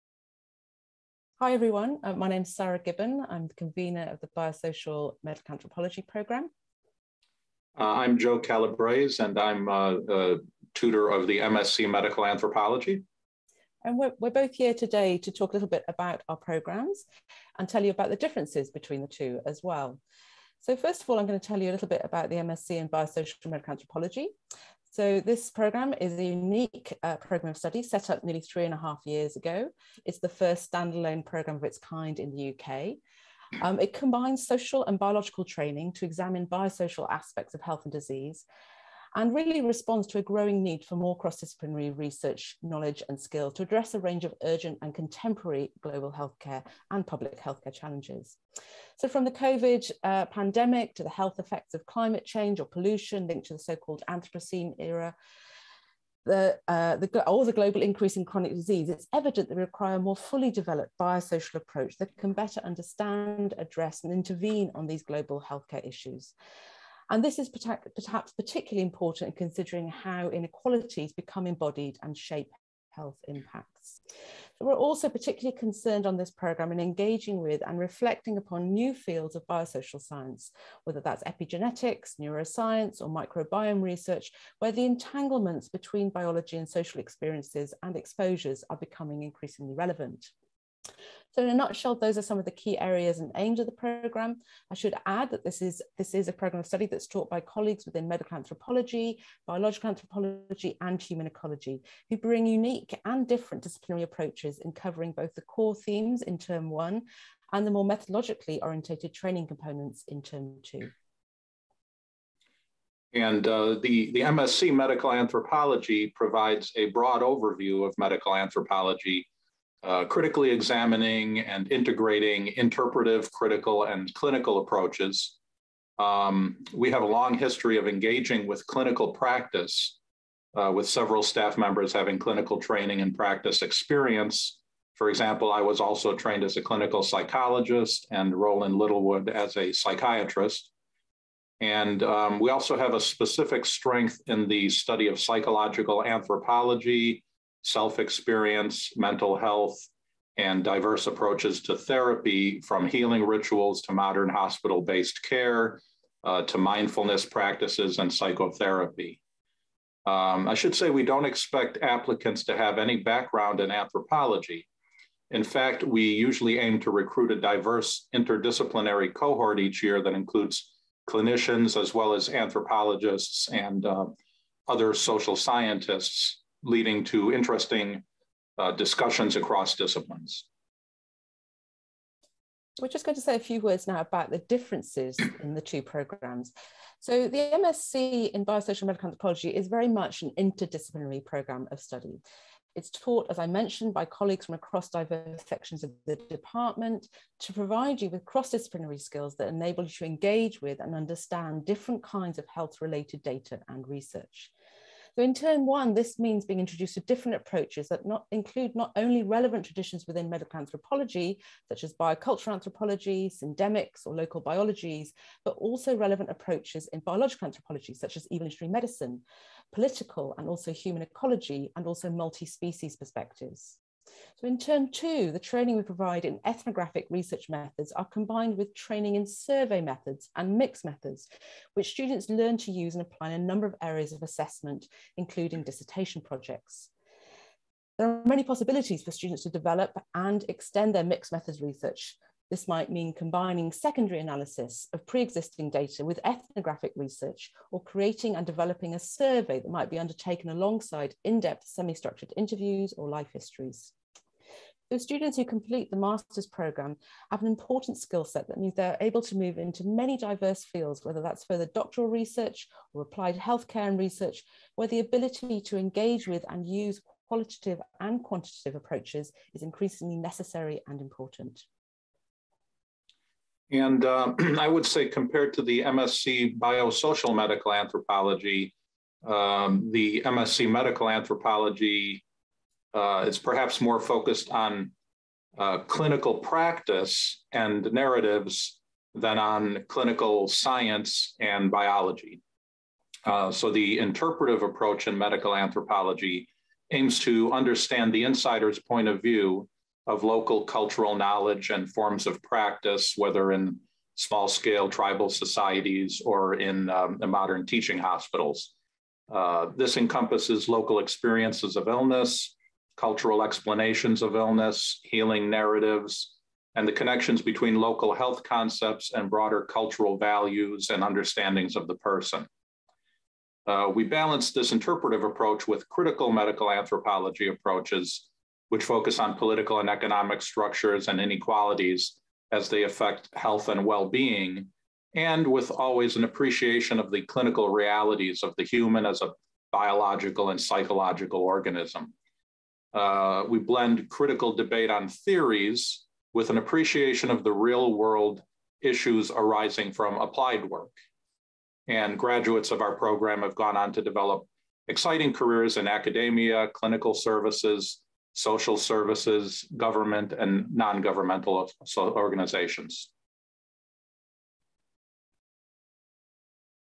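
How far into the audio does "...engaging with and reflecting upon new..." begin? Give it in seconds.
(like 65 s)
76 s.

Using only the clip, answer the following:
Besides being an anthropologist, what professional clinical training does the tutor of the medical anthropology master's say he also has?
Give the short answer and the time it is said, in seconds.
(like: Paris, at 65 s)
Clinical psychologist, at 136 s.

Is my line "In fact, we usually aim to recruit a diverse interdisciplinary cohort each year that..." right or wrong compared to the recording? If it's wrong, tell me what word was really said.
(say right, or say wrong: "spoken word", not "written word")
right.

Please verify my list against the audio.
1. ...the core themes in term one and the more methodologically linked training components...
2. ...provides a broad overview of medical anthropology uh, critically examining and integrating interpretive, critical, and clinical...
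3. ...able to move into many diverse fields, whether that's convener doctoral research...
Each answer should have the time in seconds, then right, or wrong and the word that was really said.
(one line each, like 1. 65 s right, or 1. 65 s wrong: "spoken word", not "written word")
1. 105 s wrong: "orientated", not "linked"
2. 116 s right
3. 258 s wrong: "further", not "convener".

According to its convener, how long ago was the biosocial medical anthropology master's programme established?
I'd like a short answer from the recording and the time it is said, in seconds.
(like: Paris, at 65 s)
3.5 years, at 28 s.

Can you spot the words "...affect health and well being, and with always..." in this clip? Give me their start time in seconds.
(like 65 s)
332 s.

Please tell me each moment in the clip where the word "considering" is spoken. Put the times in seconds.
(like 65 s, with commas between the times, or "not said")
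69 s.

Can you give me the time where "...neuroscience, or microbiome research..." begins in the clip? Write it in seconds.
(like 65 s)
82 s.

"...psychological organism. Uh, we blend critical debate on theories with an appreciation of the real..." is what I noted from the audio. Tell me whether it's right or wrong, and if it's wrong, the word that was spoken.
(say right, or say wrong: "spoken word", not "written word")
right.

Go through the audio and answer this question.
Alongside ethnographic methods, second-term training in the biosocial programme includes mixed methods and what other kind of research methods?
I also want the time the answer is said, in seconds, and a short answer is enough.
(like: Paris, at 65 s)
Survey methods, at 229 s.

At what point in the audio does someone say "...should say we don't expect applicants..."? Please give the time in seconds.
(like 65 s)
160 s.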